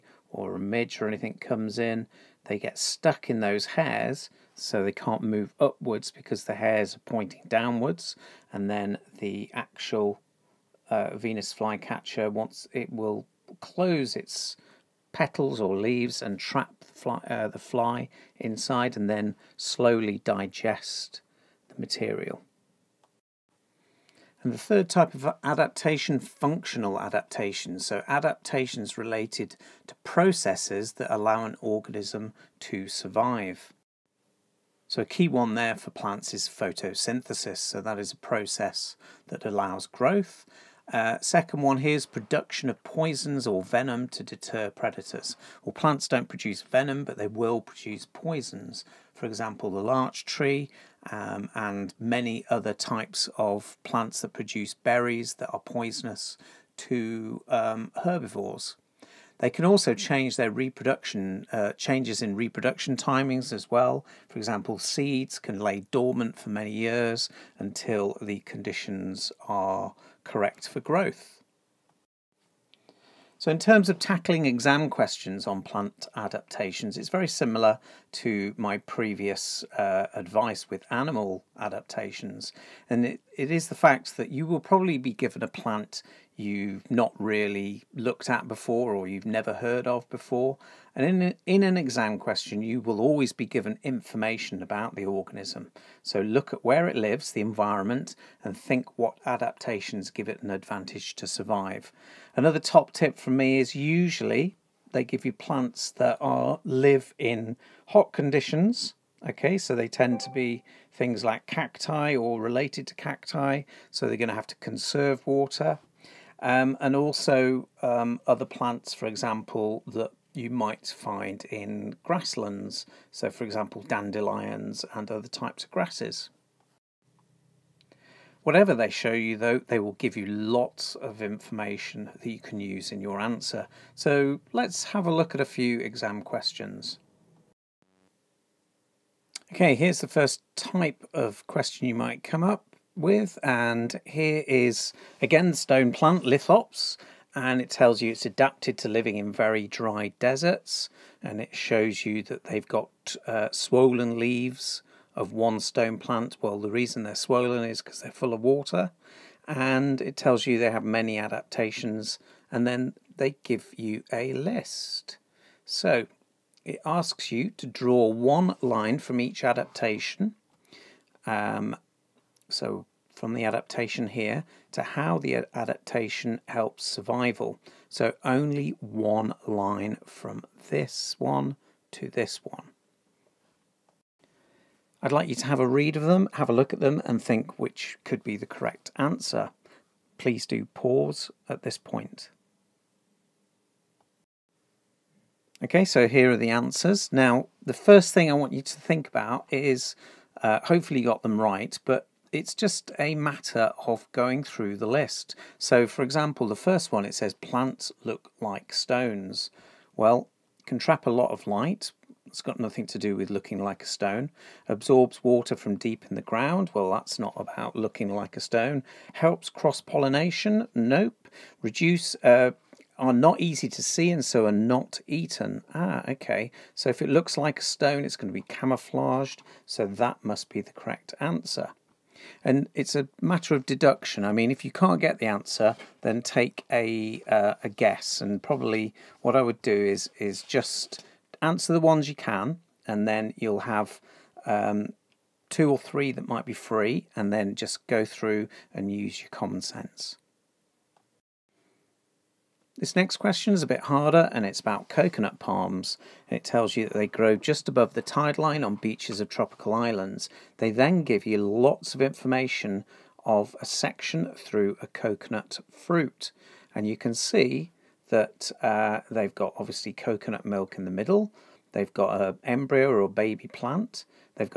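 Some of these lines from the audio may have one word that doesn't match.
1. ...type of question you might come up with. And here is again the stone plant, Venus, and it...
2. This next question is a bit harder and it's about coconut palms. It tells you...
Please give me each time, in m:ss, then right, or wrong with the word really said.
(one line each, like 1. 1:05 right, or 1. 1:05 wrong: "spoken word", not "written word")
1. 2:20 wrong: "Lithops", not "Venus"
2. 4:12 right.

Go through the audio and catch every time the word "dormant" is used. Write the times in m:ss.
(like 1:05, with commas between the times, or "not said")
1:05.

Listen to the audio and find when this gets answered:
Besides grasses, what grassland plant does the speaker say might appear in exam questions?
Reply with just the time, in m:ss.
2:03.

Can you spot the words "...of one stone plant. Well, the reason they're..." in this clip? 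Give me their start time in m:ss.
2:35.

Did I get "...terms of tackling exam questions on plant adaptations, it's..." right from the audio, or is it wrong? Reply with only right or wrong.
right.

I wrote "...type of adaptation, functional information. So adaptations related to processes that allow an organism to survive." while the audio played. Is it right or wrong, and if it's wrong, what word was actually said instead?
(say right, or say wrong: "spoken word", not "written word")
wrong: "adaptation", not "information".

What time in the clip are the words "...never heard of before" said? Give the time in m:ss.
1:29.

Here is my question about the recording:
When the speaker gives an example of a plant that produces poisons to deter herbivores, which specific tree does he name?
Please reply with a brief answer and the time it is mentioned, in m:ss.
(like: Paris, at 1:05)
larch tree, at 0:49.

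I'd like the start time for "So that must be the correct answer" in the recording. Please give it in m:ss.
3:49.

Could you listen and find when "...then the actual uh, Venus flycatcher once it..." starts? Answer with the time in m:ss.
0:08.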